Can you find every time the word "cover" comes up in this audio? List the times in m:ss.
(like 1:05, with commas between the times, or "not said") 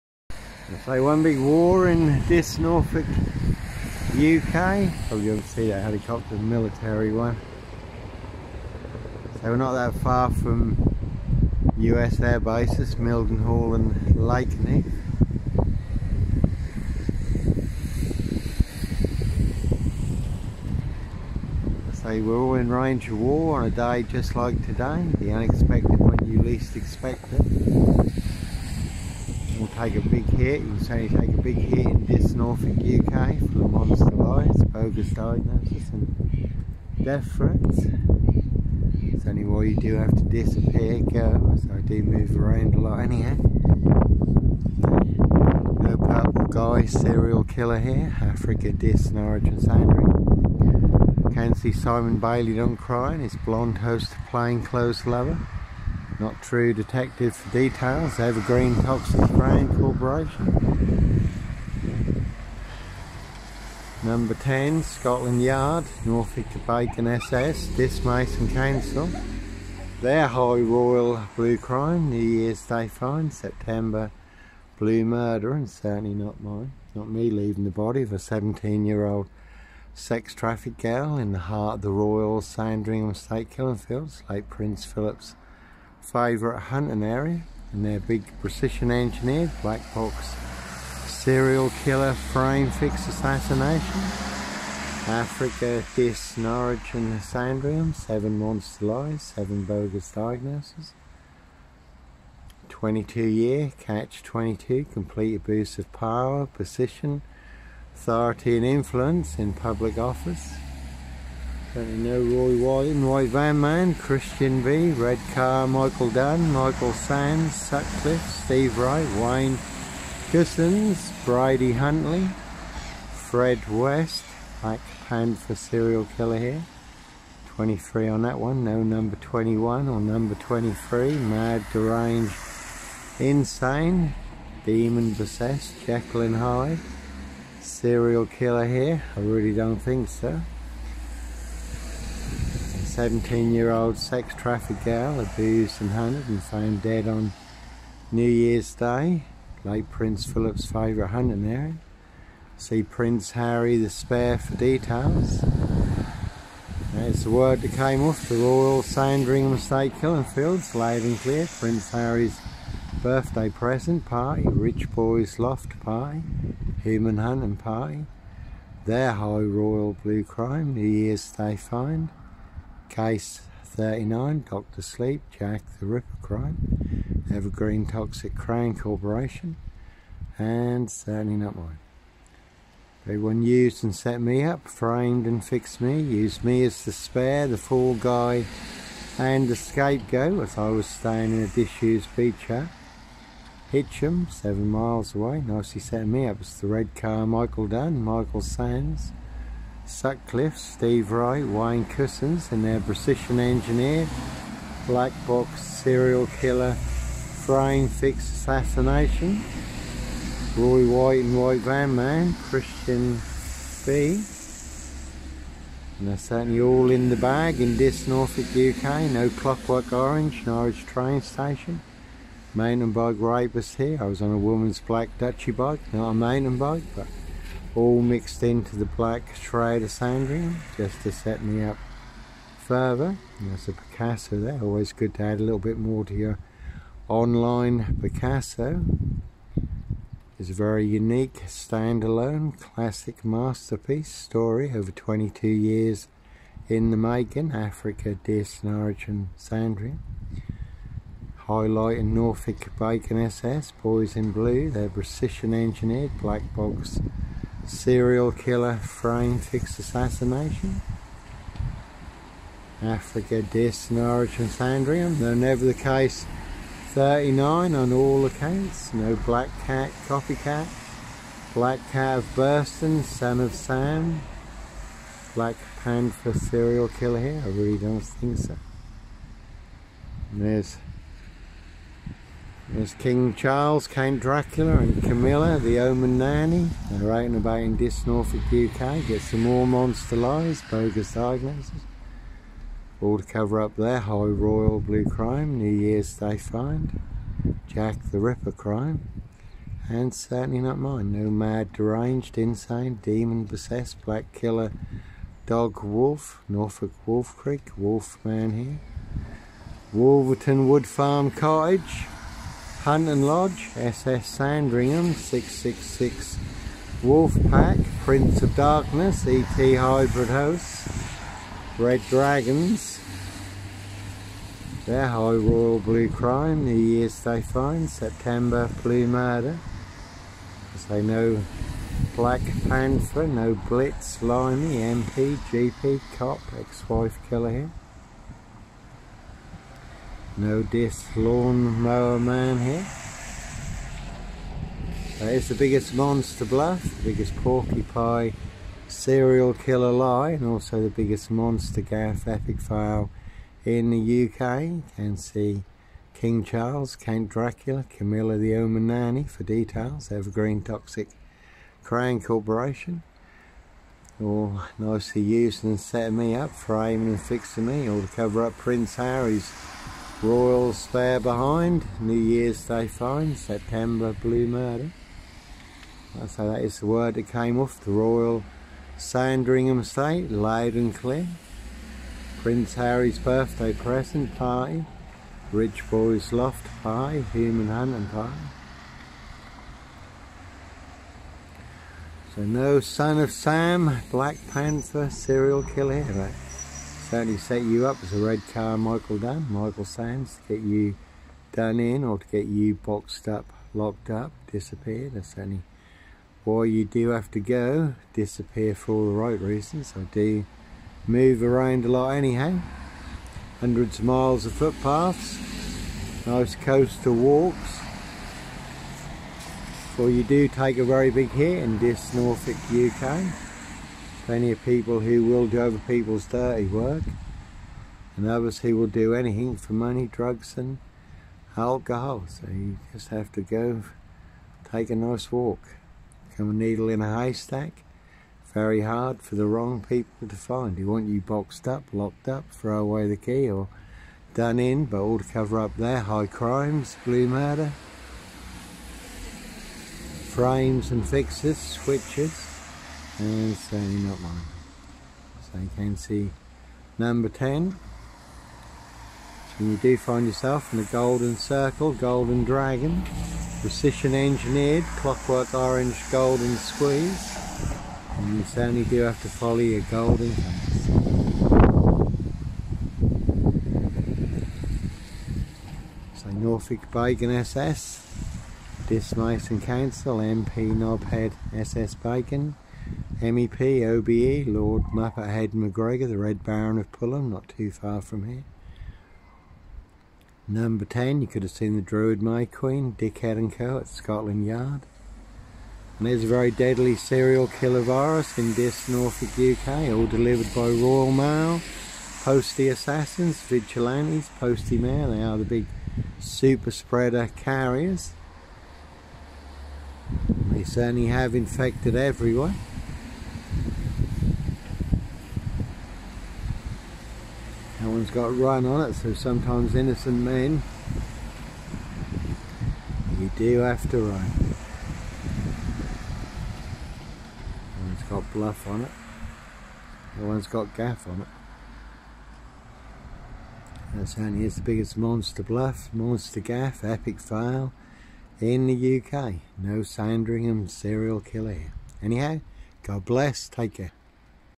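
4:53, 6:08, 7:25.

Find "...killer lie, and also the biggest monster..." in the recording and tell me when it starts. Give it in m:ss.
5:49.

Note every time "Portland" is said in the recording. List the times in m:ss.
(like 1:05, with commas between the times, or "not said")
not said.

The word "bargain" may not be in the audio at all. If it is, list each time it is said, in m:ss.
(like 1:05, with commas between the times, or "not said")
not said.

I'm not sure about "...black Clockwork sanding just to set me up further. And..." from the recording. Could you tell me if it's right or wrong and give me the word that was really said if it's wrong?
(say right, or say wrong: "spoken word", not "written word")
wrong: "Schrader", not "Clockwork".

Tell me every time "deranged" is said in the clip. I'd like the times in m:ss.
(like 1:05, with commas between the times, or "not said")
2:11, 5:01.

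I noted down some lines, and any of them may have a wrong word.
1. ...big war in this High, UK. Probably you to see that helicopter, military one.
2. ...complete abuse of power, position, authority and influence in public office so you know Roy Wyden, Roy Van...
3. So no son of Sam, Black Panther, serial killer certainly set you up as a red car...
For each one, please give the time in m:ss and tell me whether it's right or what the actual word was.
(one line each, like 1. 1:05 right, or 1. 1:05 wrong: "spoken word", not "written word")
1. 0:01 wrong: "Norfolk", not "High"
2. 1:44 right
3. 6:32 right.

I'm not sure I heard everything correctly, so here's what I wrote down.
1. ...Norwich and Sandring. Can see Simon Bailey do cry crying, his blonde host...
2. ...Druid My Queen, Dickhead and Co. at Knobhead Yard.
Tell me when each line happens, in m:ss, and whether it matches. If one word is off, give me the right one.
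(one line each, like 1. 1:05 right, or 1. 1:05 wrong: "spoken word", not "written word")
1. 0:49 right
2. 8:11 wrong: "Scotland", not "Knobhead".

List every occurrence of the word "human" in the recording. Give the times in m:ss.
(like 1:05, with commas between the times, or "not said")
2:46, 6:27.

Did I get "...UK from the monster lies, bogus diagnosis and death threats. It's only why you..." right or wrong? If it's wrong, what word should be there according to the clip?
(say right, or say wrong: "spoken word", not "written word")
right.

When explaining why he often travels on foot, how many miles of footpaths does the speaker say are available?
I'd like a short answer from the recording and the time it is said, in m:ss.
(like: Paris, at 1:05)
Hundreds of miles, at 6:53.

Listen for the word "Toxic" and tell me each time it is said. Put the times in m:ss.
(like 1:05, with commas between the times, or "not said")
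0:58, 2:57, 6:00.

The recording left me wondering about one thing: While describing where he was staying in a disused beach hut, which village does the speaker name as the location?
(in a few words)
Heacham.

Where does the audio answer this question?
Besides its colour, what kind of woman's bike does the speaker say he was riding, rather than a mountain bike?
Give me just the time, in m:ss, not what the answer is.
3:45.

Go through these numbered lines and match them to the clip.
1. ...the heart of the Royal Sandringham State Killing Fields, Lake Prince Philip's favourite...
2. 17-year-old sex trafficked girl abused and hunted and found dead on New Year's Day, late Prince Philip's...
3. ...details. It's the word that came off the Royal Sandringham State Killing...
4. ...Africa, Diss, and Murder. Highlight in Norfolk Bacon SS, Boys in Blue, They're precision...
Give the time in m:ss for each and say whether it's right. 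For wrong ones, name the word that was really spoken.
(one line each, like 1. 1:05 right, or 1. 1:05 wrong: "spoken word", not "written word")
1. 1:21 right
2. 2:22 right
3. 2:34 right
4. 4:07 wrong: "Sandring", not "Murder".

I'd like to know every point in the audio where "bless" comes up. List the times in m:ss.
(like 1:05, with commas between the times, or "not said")
9:03.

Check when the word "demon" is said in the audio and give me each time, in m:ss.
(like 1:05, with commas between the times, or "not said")
2:14, 5:03.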